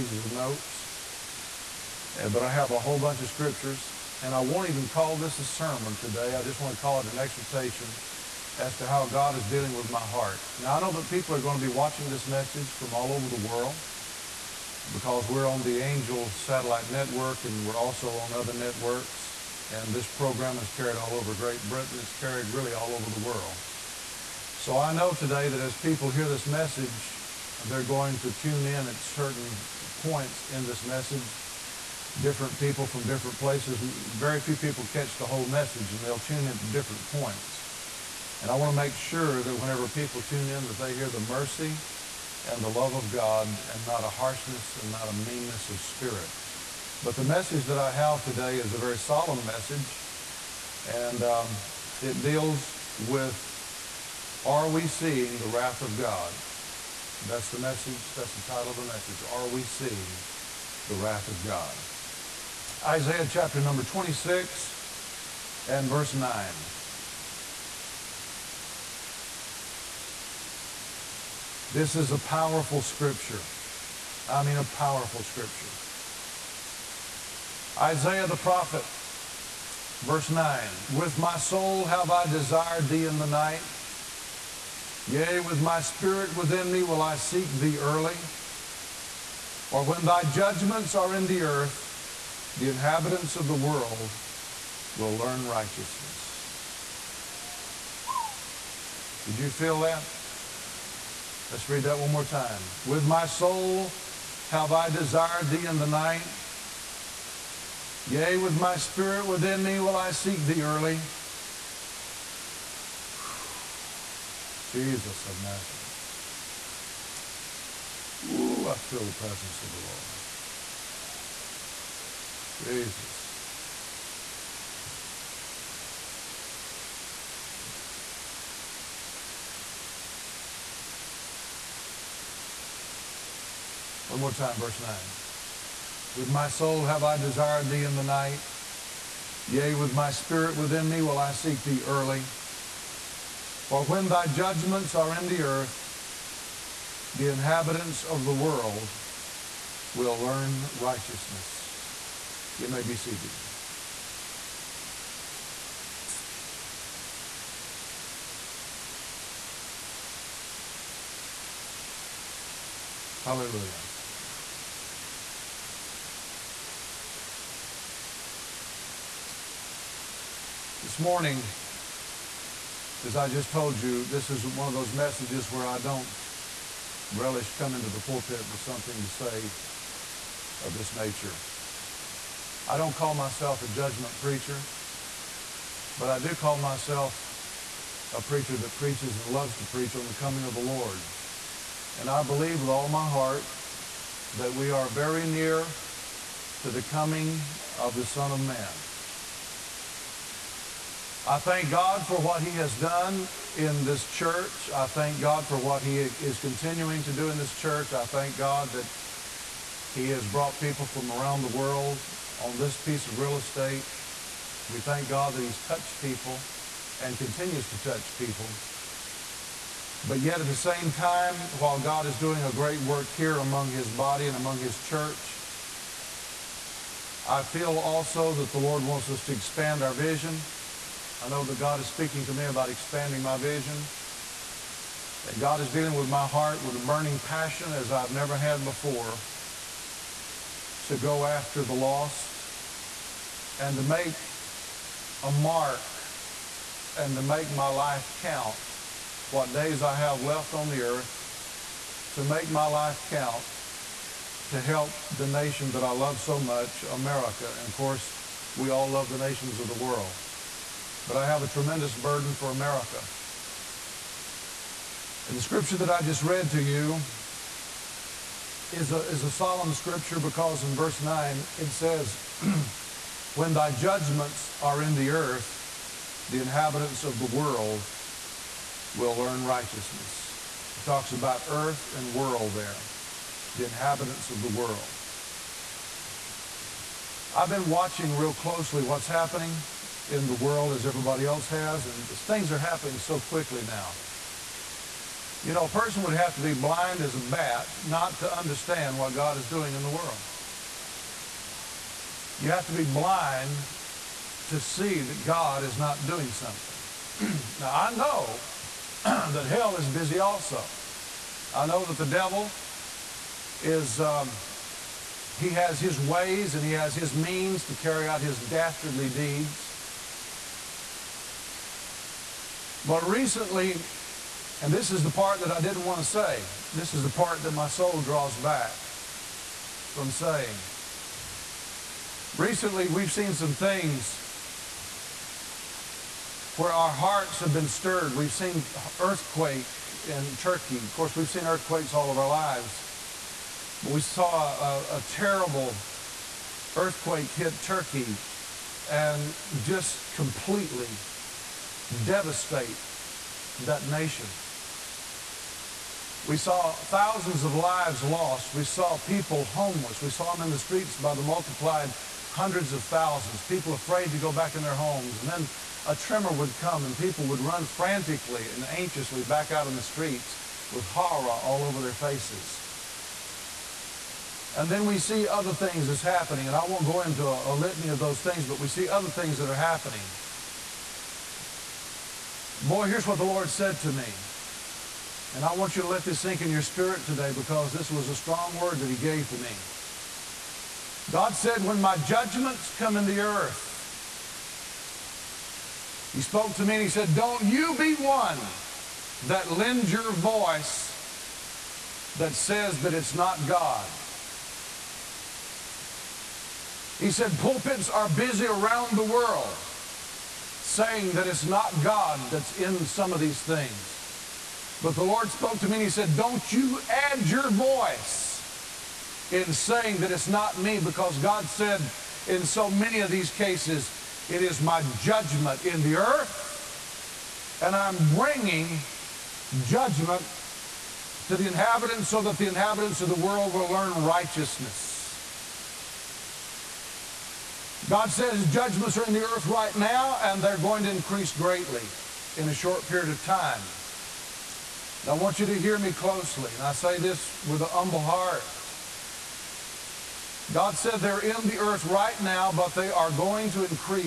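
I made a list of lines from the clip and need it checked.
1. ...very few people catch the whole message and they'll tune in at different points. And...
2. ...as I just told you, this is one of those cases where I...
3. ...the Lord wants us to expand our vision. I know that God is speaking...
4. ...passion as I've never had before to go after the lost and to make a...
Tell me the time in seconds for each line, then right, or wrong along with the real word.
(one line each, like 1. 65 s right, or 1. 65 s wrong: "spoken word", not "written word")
1. 33 s right
2. 173 s wrong: "messages", not "cases"
3. 228 s right
4. 237 s right.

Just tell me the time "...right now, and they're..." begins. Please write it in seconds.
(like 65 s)
439 s.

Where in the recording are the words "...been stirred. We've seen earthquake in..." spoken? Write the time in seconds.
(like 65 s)
337 s.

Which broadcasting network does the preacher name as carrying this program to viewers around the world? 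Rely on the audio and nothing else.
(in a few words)
Angel Satellite Network.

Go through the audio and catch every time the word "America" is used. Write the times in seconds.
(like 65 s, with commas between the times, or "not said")
256 s, 262 s.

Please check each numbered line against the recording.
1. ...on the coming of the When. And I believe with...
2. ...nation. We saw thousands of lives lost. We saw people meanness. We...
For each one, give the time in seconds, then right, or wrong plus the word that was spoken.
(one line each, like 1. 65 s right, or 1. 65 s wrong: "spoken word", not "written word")
1. 189 s wrong: "Lord", not "When"
2. 353 s wrong: "homeless", not "meanness".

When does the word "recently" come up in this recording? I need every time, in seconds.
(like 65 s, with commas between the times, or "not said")
323 s, 332 s.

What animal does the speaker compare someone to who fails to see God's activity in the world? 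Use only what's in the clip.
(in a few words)
a bat.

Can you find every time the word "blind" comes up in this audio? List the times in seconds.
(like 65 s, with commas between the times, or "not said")
296 s, 302 s.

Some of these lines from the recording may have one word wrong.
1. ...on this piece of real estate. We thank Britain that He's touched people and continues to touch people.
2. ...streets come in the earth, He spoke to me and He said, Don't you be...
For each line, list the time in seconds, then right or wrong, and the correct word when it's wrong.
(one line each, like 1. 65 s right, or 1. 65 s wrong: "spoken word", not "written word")
1. 212 s wrong: "God", not "Britain"
2. 391 s wrong: "judgments", not "streets".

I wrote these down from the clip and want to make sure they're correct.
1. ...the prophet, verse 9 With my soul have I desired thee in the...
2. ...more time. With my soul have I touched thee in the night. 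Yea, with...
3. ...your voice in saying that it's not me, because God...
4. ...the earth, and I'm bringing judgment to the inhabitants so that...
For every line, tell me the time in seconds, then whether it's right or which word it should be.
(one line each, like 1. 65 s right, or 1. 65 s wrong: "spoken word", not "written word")
1. 78 s right
2. 102 s wrong: "desired", not "touched"
3. 417 s right
4. 425 s right.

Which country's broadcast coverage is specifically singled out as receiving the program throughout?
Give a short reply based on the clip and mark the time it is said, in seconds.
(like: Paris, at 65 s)
Great Britain, at 21 s.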